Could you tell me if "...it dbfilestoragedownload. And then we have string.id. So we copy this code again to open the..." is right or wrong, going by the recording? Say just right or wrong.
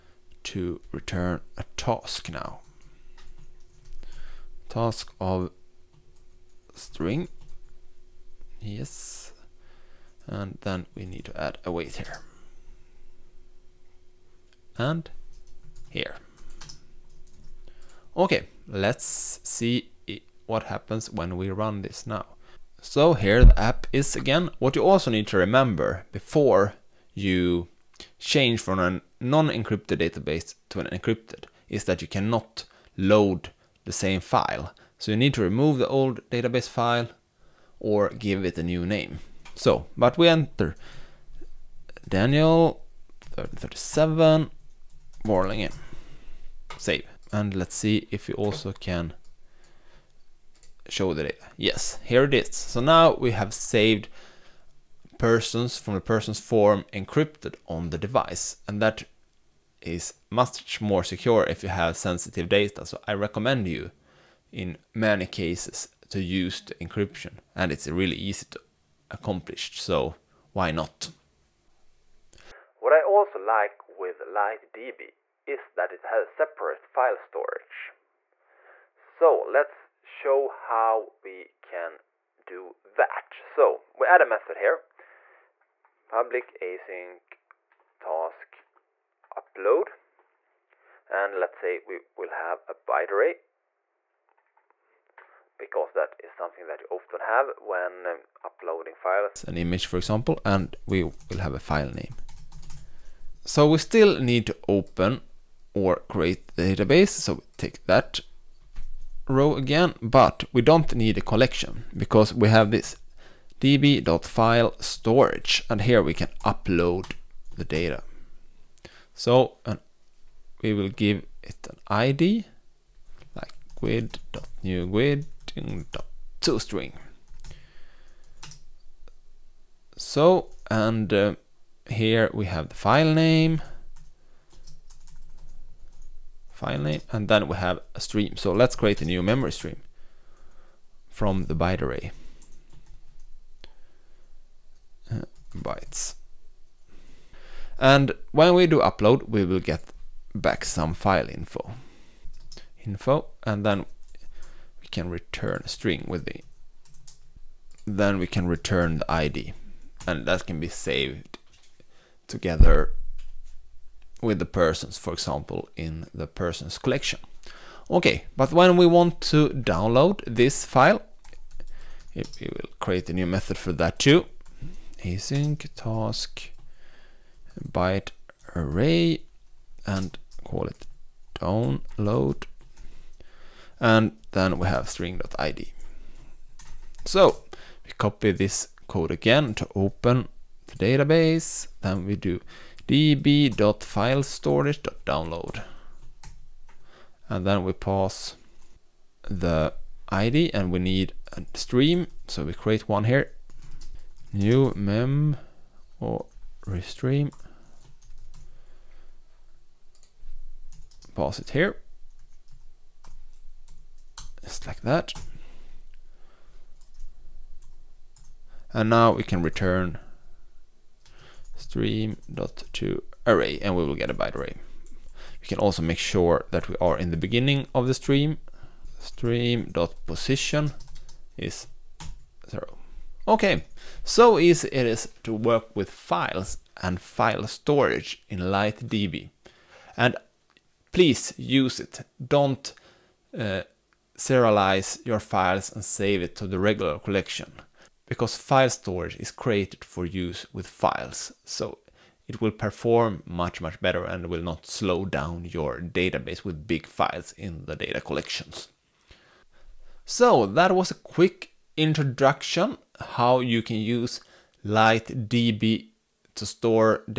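wrong.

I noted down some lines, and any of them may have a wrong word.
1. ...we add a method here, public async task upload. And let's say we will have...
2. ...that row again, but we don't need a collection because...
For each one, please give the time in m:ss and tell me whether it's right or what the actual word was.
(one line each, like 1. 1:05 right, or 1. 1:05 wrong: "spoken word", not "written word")
1. 1:23 right
2. 1:47 right.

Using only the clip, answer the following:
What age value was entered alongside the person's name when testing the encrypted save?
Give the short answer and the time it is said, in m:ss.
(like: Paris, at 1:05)
37, at 0:43.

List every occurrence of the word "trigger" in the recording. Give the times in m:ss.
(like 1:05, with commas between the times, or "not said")
not said.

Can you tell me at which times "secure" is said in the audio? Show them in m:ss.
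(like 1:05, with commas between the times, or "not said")
1:01.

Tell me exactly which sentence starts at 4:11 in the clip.
So it will perform much, much better and will not slow down your database with big files in the data collections.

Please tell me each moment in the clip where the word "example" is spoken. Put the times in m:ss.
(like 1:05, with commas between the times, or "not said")
1:39, 2:45.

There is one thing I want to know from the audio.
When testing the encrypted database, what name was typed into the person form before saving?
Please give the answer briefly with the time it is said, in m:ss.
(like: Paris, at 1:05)
Daniel, at 0:42.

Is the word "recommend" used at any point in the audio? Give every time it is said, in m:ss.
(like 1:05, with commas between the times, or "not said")
1:03.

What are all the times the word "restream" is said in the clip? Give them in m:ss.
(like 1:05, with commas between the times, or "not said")
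3:26.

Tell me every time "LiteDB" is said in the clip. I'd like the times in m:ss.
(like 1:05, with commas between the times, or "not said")
1:14, 3:58, 4:24.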